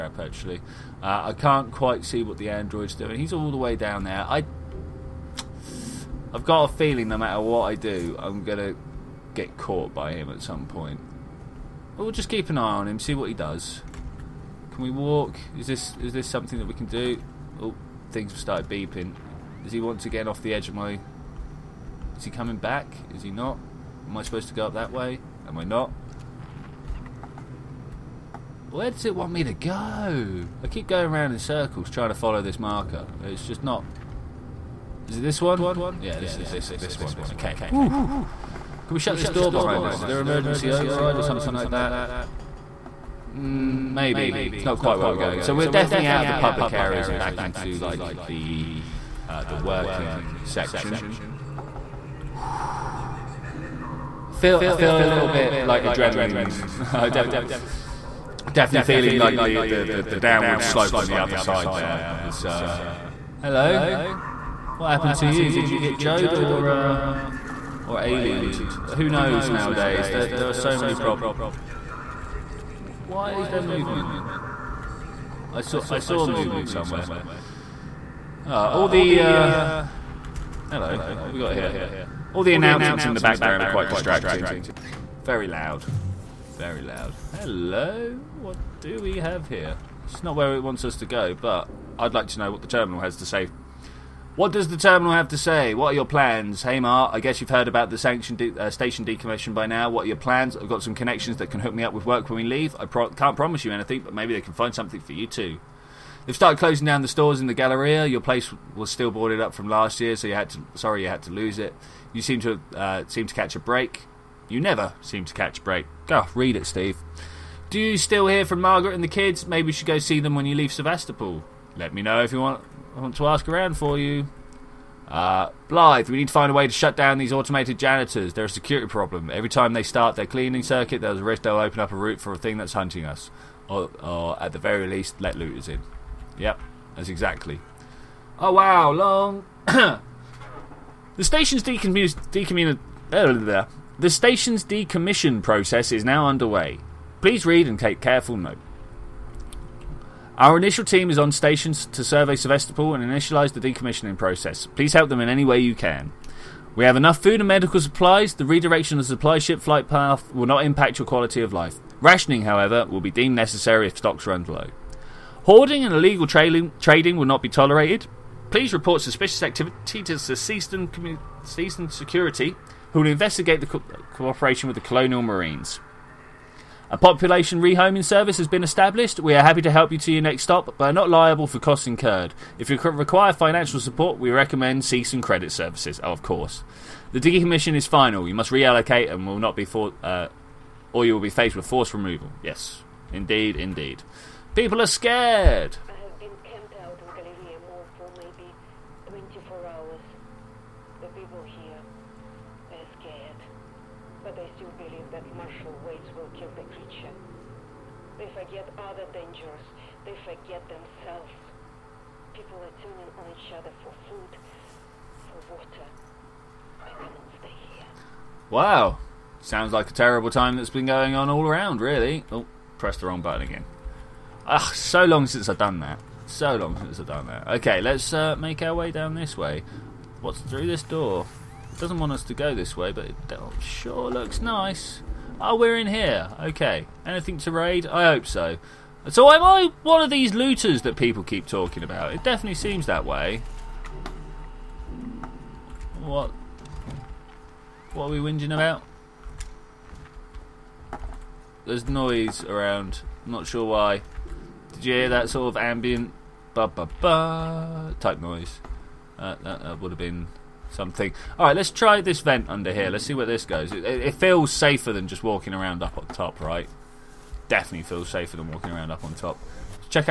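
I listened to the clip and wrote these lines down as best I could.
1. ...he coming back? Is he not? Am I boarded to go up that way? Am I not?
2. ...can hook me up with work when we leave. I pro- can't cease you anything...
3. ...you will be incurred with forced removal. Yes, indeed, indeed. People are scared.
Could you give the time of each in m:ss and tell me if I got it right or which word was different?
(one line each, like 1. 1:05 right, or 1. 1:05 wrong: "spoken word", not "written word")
1. 0:22 wrong: "supposed", not "boarded"
2. 1:41 wrong: "promise", not "cease"
3. 3:11 wrong: "faced", not "incurred".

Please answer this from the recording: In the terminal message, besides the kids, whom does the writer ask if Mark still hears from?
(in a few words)
Margaret.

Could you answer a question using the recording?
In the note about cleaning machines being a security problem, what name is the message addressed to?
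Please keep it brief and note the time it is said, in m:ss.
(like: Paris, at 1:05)
Blythe, at 2:05.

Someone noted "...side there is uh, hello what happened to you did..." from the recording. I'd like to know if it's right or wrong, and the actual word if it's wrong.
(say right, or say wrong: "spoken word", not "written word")
right.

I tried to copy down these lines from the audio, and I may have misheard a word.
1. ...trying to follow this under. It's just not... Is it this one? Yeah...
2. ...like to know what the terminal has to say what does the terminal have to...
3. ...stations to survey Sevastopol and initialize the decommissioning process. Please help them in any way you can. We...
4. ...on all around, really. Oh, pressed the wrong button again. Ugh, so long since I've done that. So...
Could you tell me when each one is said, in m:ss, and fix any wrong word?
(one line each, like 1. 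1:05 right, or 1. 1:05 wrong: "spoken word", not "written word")
1. 0:31 wrong: "marker", not "under"
2. 1:32 right
3. 2:31 right
4. 3:41 right.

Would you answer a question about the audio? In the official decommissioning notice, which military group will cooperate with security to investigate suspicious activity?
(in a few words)
Colonial Marines.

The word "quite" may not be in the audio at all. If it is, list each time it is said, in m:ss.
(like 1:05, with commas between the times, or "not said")
0:01, 0:44, 1:23.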